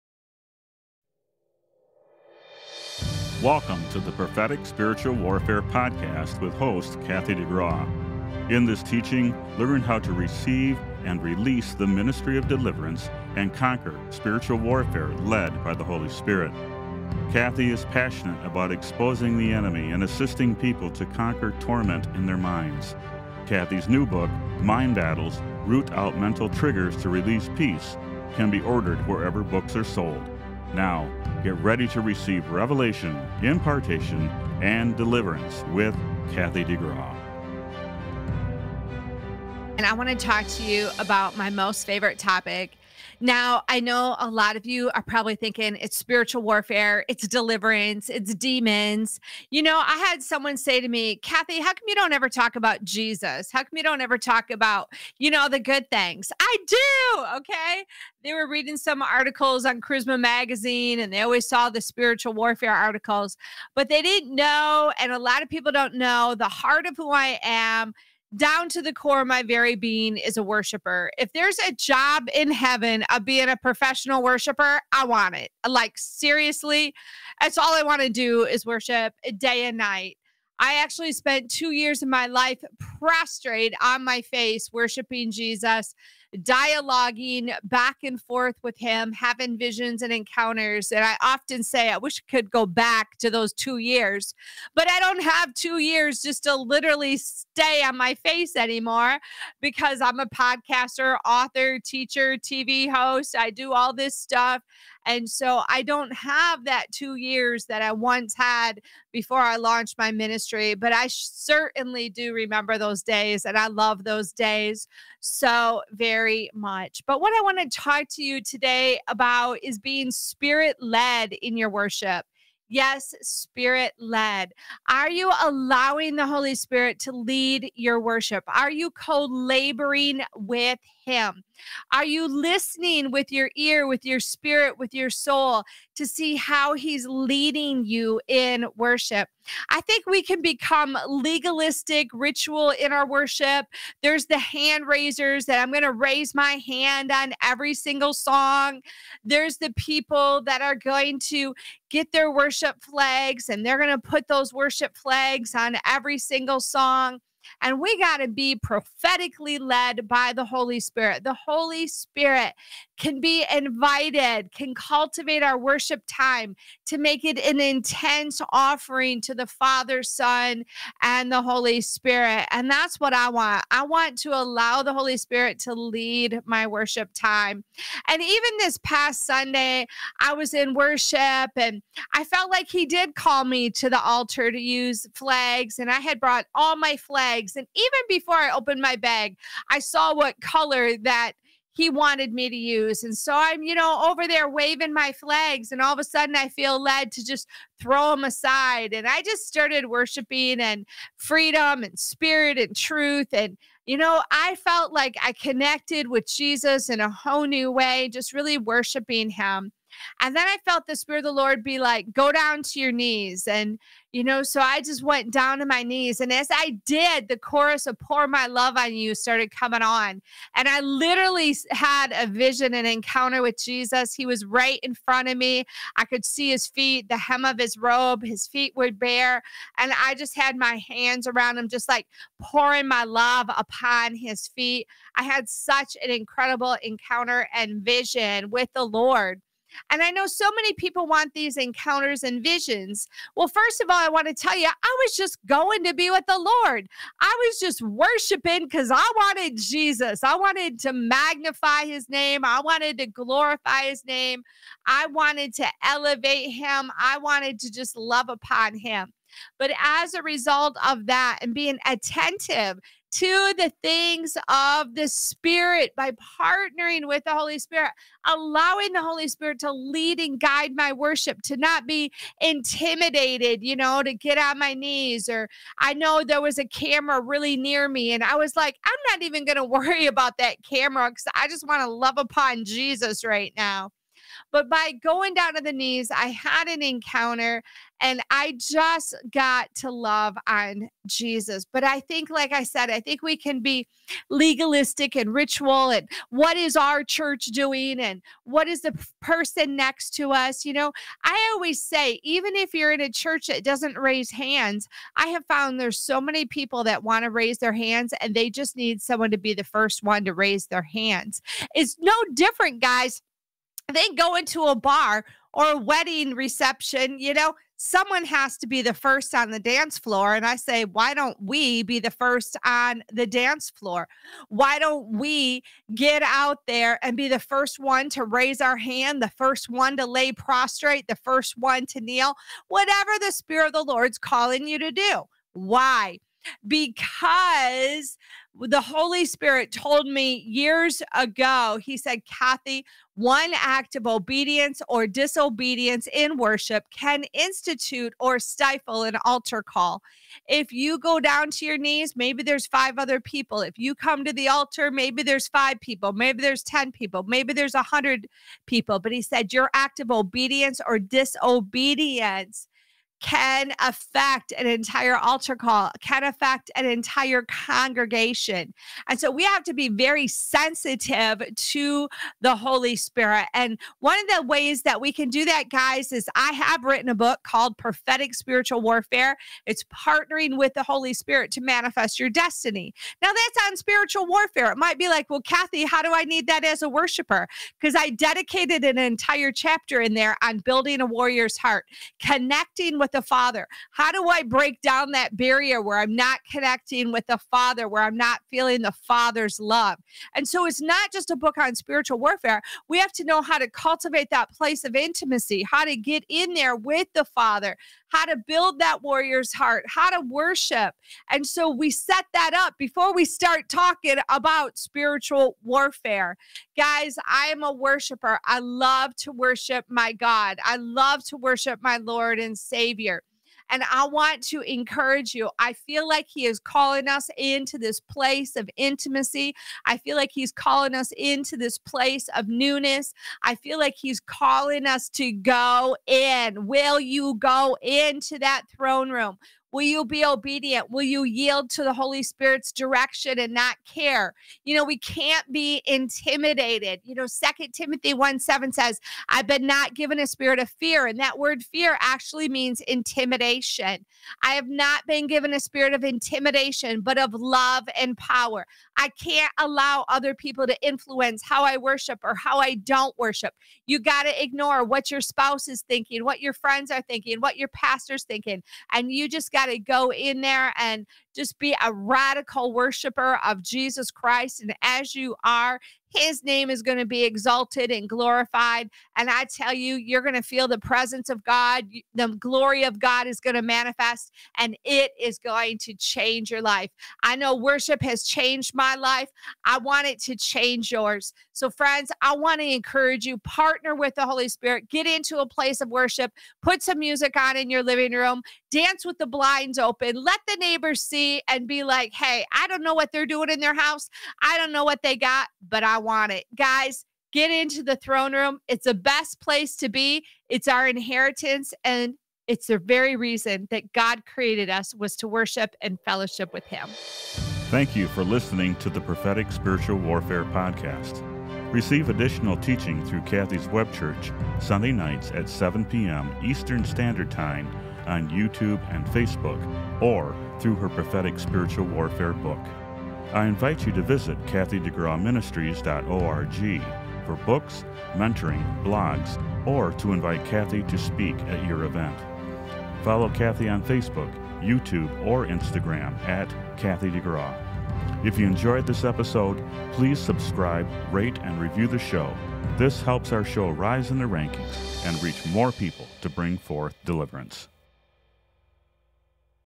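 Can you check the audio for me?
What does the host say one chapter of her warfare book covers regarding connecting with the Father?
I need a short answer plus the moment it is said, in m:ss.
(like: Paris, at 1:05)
building a warrior's heart, at 6:30.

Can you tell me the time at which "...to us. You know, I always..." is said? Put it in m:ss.
5:00.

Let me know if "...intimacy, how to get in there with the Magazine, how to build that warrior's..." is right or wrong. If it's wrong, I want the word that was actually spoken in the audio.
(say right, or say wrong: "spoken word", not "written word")
wrong: "Father", not "Magazine".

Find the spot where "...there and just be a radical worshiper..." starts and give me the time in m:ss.
7:50.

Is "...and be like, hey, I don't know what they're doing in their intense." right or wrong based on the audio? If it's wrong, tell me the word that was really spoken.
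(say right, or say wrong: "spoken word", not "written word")
wrong: "house", not "intense".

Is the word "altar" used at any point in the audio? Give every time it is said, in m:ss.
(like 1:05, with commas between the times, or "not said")
3:04, 5:49, 5:54, 6:05.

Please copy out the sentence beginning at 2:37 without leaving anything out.
And we got to be prophetically led by the Holy Spirit.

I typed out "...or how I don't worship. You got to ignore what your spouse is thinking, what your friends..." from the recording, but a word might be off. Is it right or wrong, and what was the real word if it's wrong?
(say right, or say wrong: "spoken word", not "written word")
right.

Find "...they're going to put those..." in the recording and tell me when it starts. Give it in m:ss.
2:33.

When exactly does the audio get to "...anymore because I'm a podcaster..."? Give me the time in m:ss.
1:38.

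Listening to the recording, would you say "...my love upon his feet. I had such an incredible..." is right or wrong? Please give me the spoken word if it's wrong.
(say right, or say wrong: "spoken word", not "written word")
right.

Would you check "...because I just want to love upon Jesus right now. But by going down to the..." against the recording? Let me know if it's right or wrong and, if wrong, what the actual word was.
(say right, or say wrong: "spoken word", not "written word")
right.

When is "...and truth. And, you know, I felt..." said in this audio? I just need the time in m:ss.
3:22.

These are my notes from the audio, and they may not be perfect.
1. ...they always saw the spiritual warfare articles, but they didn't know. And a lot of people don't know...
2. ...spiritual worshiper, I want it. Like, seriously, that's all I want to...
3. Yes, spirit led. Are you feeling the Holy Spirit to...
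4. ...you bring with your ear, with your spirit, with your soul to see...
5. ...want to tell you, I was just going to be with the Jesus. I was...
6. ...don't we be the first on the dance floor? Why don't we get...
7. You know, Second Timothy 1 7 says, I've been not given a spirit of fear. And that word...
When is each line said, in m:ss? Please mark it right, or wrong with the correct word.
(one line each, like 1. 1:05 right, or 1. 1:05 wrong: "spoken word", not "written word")
1. 1:01 right
2. 1:13 wrong: "professional", not "spiritual"
3. 2:02 wrong: "allowing", not "feeling"
4. 2:12 wrong: "listening", not "bring"
5. 4:04 wrong: "Lord", not "Jesus"
6. 5:21 right
7. 7:27 right.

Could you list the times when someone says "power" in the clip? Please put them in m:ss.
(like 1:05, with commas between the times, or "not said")
7:38.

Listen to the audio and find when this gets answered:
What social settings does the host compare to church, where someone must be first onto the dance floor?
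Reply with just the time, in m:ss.
5:14.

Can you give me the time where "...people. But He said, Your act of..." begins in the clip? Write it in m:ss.
5:58.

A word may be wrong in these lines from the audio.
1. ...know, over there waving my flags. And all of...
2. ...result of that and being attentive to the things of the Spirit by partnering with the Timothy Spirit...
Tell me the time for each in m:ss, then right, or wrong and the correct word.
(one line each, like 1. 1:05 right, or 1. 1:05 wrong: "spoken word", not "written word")
1. 3:13 right
2. 4:20 wrong: "Holy", not "Timothy".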